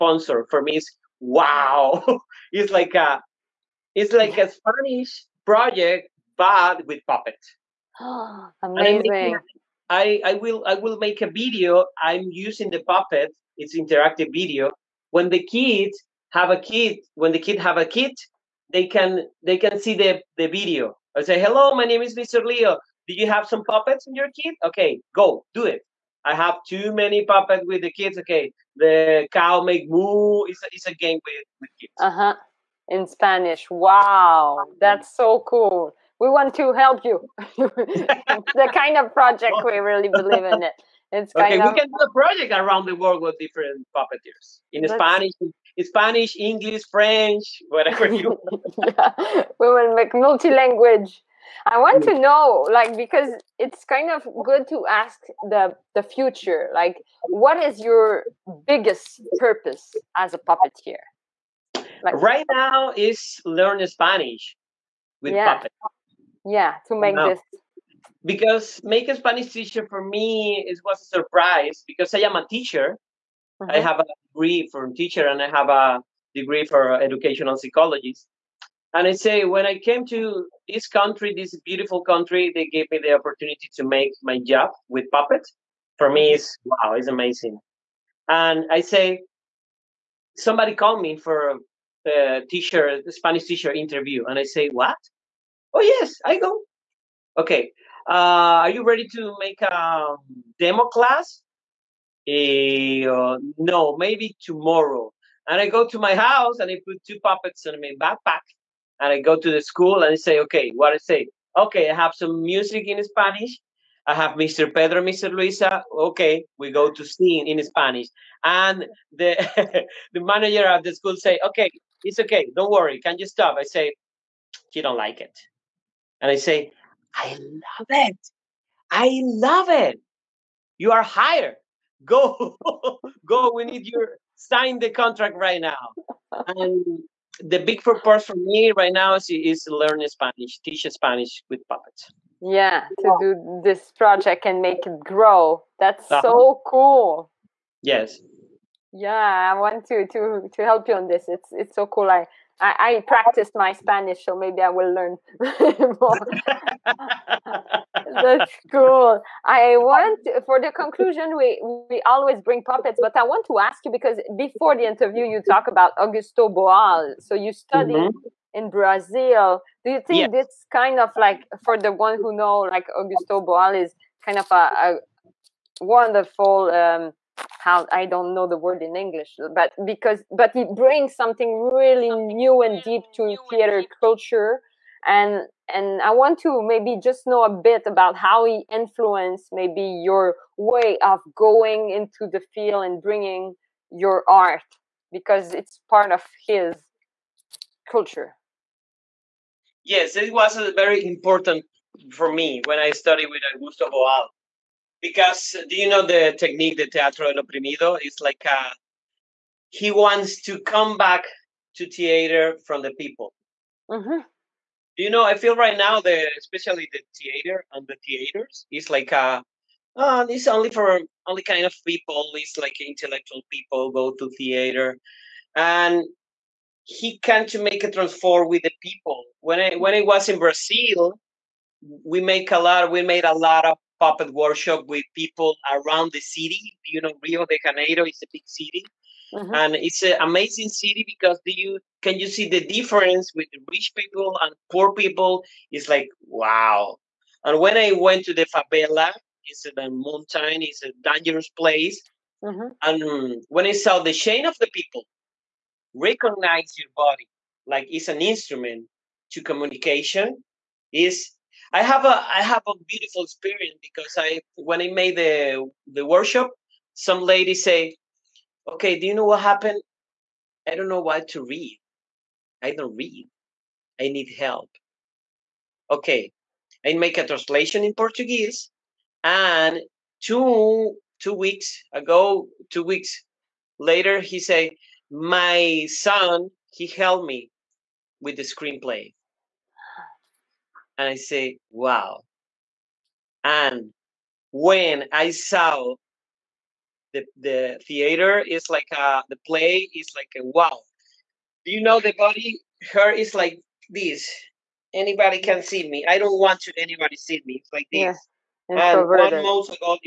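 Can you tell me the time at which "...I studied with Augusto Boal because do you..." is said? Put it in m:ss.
3:22.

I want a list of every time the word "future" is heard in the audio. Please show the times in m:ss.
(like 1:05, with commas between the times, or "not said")
0:56.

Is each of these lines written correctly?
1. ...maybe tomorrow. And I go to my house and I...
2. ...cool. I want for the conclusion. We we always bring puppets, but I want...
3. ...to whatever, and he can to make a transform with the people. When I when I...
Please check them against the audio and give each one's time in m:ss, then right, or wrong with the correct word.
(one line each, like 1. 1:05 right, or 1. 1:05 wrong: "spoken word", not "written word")
1. 1:43 right
2. 2:38 right
3. 3:44 wrong: "theater", not "whatever".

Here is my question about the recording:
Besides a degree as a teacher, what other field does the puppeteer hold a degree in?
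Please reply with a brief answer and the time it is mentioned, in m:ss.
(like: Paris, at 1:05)
Educational psychology, at 1:16.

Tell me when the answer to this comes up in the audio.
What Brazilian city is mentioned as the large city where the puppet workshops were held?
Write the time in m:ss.
3:57.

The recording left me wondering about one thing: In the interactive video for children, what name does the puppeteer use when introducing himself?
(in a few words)
Mr. Leo.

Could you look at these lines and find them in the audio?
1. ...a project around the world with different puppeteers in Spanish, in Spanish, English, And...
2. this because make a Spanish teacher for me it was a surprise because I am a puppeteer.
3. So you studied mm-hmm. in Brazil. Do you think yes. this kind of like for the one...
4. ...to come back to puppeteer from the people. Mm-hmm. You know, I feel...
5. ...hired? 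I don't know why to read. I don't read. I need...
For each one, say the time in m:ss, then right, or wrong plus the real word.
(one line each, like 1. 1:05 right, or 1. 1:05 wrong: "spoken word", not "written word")
1. 0:42 wrong: "French", not "And"
2. 1:07 wrong: "teacher", not "puppeteer"
3. 2:47 right
4. 3:30 wrong: "theater", not "puppeteer"
5. 4:29 wrong: "happened", not "hired".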